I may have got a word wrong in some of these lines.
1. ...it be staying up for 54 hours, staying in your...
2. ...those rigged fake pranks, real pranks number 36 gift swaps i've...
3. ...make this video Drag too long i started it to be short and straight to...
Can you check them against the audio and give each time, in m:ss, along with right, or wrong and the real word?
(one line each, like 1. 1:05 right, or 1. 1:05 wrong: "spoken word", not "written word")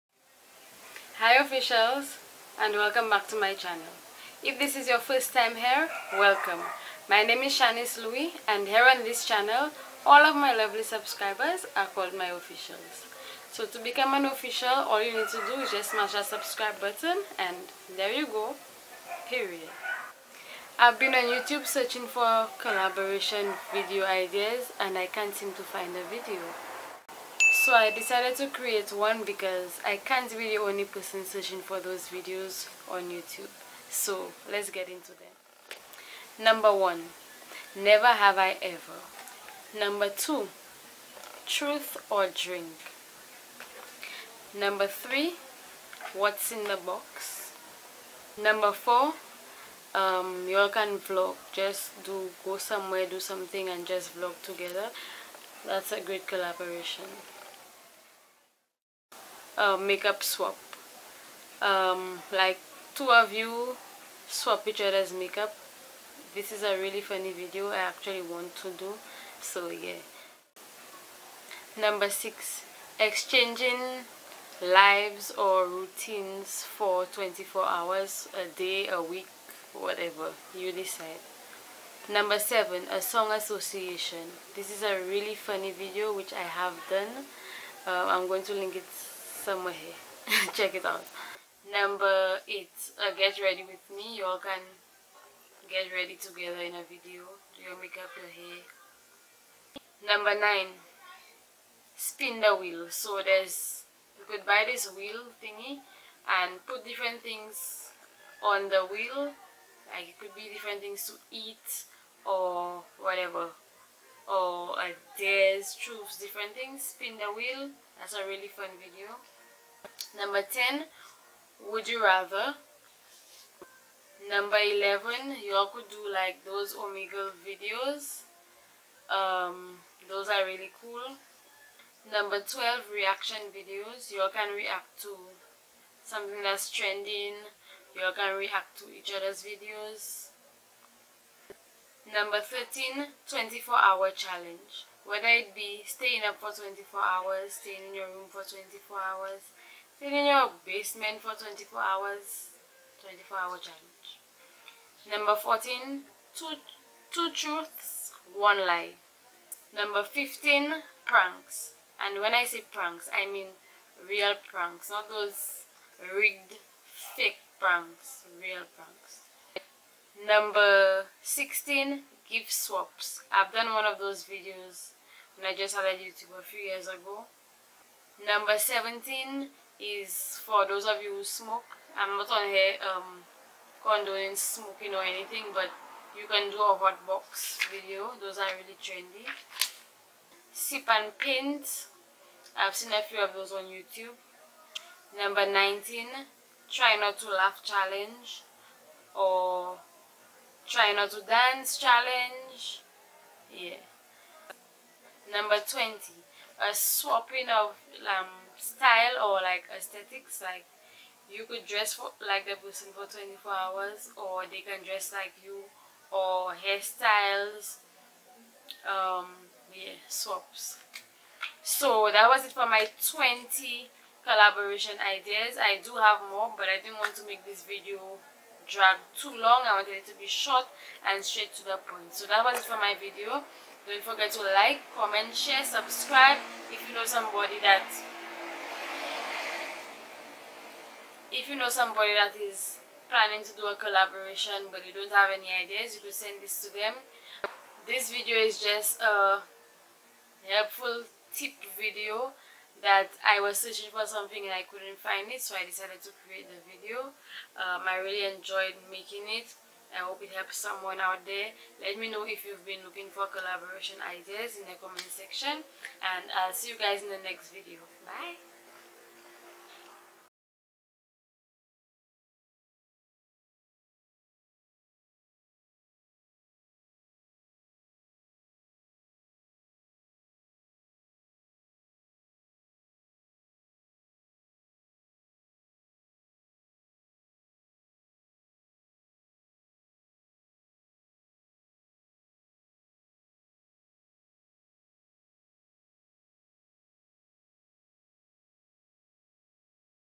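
1. 2:25 wrong: "24", not "54"
2. 2:45 wrong: "16", not "36"
3. 3:47 wrong: "wanted", not "started".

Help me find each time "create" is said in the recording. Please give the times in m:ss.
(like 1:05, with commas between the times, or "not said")
0:28, 4:16.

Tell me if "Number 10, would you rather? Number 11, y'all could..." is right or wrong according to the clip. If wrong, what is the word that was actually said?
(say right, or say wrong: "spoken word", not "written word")
right.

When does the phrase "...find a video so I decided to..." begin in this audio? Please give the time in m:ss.
0:25.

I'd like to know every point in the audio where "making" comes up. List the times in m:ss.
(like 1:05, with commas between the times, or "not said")
4:18.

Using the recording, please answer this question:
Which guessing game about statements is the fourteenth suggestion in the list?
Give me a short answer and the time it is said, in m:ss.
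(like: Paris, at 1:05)
Two truths, one lie, at 2:37.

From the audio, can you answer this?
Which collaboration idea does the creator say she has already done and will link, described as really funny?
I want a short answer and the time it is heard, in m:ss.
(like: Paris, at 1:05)
Song association, at 1:22.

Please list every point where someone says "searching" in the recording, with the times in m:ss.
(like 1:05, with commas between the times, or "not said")
0:21, 0:31, 4:13.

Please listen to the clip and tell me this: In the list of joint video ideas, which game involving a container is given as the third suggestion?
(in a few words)
What's in the box.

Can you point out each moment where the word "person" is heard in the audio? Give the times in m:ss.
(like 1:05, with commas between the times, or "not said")
0:30, 3:32.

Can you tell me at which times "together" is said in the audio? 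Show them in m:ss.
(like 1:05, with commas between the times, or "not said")
0:54, 1:36.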